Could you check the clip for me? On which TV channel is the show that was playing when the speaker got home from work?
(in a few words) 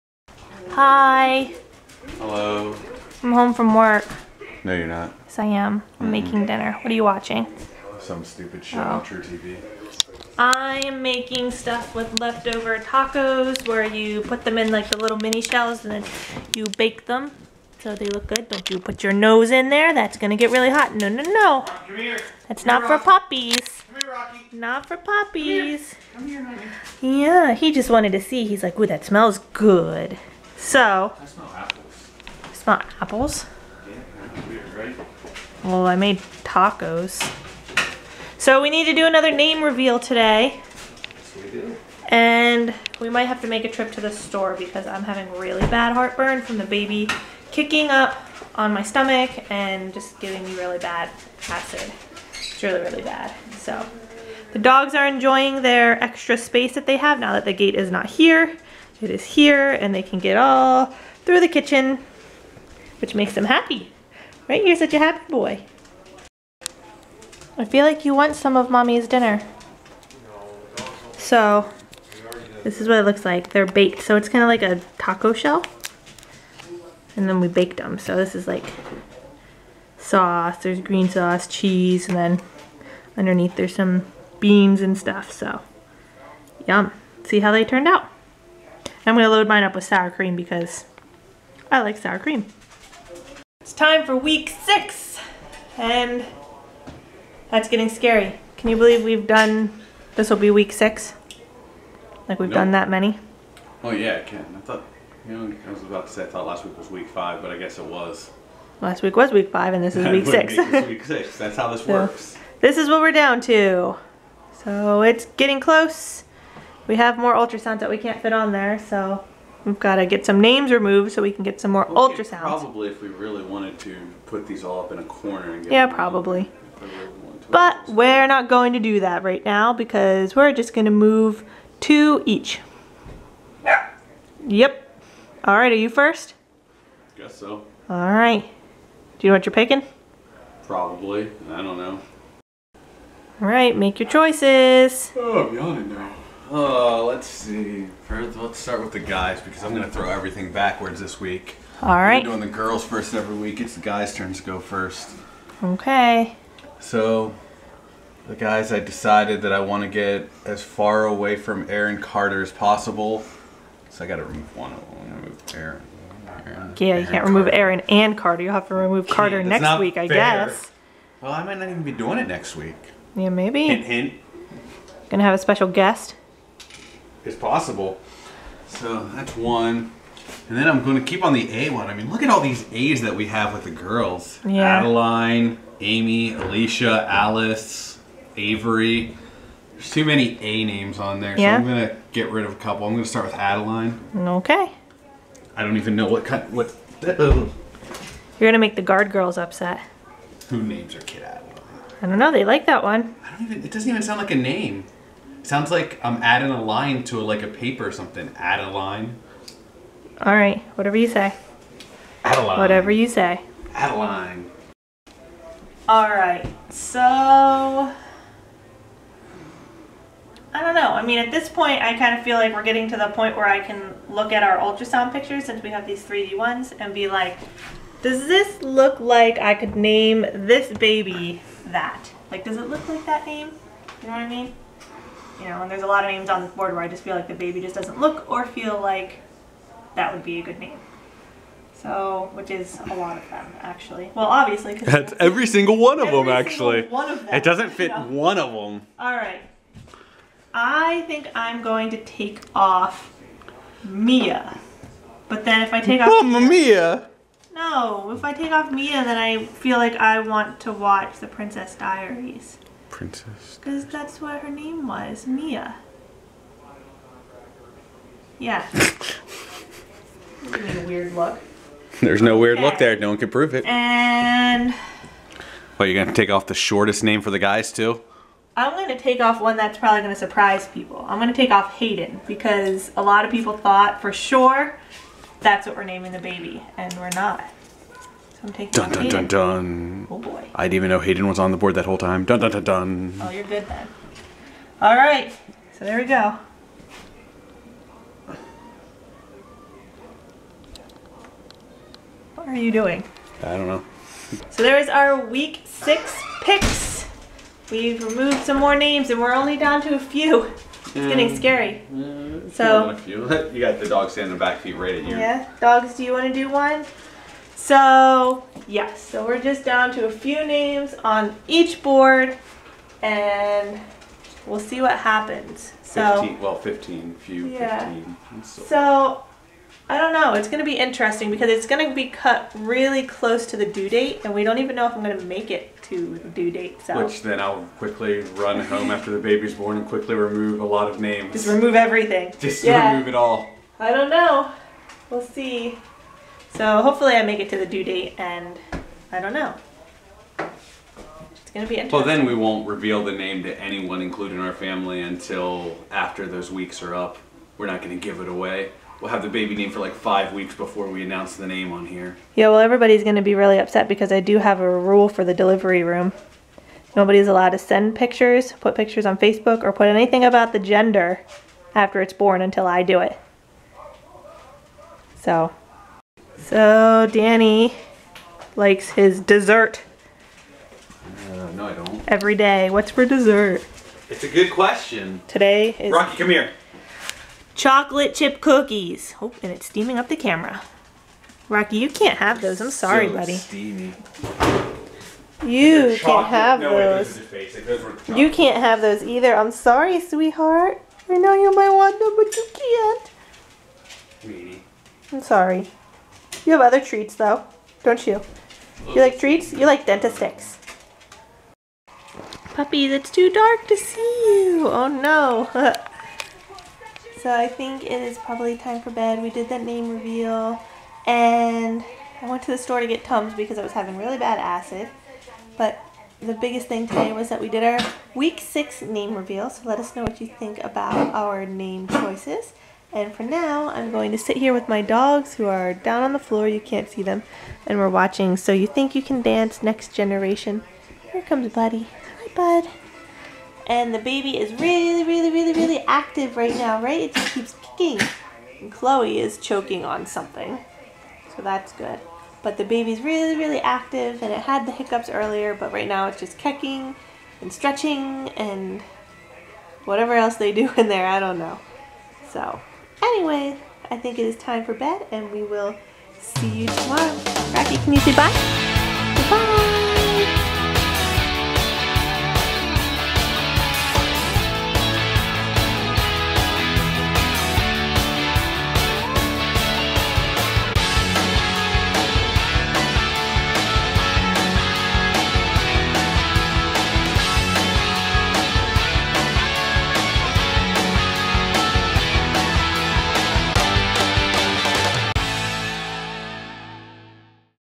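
truTV.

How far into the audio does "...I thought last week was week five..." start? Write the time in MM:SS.
01:46.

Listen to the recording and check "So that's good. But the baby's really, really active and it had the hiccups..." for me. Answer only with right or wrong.
right.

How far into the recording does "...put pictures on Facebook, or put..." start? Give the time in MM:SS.
06:08.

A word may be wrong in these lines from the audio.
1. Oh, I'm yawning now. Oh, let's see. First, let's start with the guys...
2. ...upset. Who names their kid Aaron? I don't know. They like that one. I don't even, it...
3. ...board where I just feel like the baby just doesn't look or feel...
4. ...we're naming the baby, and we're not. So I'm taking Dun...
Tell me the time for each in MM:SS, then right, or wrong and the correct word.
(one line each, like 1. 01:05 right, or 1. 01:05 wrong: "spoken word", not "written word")
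1. 02:25 right
2. 03:19 wrong: "Adeline", not "Aaron"
3. 03:56 right
4. 04:45 right.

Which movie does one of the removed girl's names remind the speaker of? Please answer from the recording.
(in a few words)
The Princess Diaries.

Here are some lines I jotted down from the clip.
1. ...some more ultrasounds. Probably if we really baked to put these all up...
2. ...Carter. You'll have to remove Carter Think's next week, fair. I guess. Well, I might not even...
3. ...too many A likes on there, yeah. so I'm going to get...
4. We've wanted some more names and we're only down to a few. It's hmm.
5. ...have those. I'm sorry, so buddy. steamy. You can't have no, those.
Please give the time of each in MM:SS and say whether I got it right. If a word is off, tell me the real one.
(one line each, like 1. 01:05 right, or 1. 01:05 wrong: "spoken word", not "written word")
1. 02:01 wrong: "wanted", not "baked"
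2. 02:48 wrong: "That", not "Think"
3. 03:09 wrong: "names", not "likes"
4. 05:07 wrong: "removed", not "wanted"
5. 06:32 right.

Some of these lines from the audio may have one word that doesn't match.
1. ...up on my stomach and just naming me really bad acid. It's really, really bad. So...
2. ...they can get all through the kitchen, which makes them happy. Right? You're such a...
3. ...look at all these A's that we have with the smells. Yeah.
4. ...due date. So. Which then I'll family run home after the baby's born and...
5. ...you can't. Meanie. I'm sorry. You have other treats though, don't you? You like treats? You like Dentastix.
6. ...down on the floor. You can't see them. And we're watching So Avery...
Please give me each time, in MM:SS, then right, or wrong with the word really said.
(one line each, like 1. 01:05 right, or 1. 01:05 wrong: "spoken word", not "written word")
1. 00:47 wrong: "giving", not "naming"
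2. 00:59 right
3. 03:02 wrong: "girls", not "smells"
4. 05:36 wrong: "quickly", not "family"
5. 06:42 right
6. 07:15 wrong: "You", not "Avery".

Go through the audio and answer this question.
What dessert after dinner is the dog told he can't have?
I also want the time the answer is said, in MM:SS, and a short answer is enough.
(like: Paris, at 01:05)
Chocolate chip cookies, at 06:27.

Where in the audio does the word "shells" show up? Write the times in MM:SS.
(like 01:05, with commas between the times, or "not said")
00:15, 01:15.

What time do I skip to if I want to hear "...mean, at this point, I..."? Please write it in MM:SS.
03:41.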